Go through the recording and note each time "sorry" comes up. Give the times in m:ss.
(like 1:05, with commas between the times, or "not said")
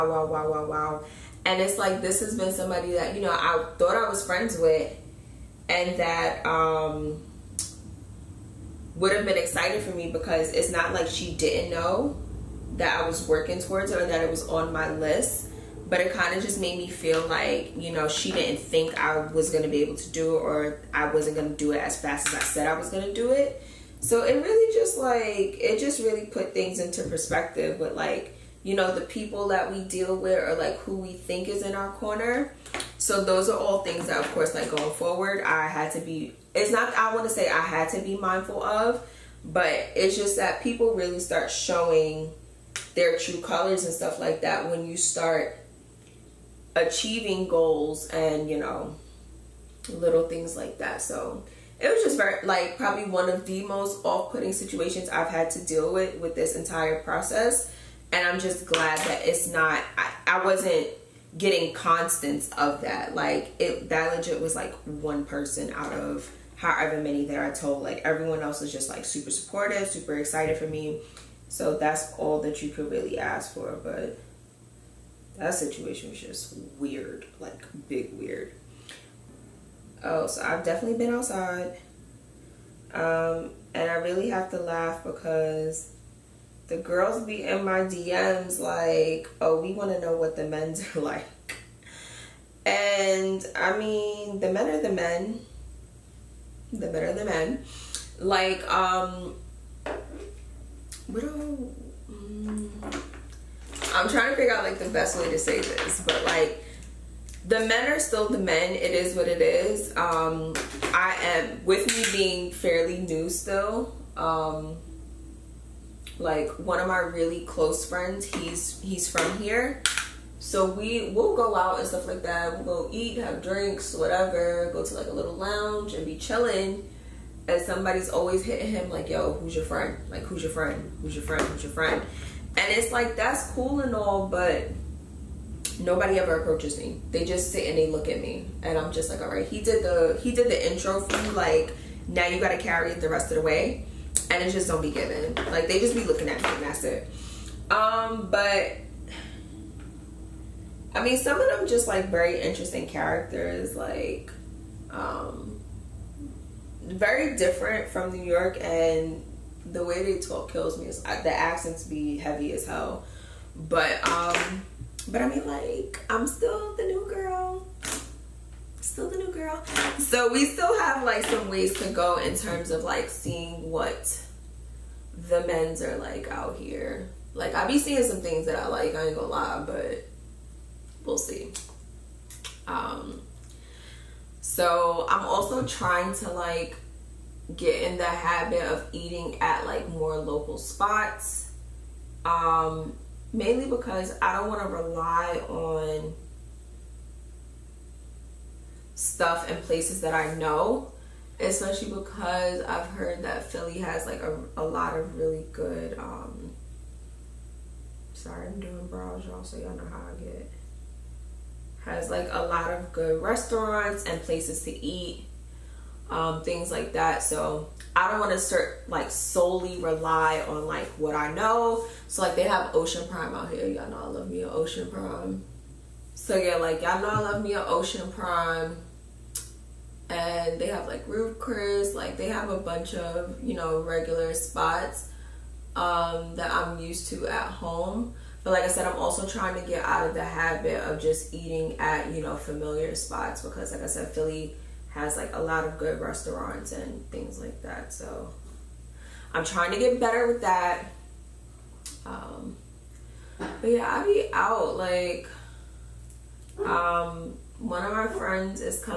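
3:28.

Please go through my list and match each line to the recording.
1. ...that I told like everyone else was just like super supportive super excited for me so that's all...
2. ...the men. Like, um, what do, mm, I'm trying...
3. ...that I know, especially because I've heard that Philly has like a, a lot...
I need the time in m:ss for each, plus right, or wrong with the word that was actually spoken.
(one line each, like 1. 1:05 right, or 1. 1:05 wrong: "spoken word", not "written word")
1. 1:07 right
2. 1:37 right
3. 3:20 right.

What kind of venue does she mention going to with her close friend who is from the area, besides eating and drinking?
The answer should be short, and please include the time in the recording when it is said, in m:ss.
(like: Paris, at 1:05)
a little lounge, at 2:05.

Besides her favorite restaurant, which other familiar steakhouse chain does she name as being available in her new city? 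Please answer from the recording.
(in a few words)
Ruth's Chris.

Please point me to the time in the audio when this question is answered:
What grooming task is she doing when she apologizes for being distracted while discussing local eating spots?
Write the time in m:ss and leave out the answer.
3:28.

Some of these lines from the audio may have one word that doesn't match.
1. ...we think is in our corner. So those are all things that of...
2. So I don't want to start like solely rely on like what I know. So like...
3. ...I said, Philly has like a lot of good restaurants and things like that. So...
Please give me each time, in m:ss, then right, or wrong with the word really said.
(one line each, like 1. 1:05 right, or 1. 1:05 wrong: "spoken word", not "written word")
1. 0:30 right
2. 3:37 right
3. 4:03 right.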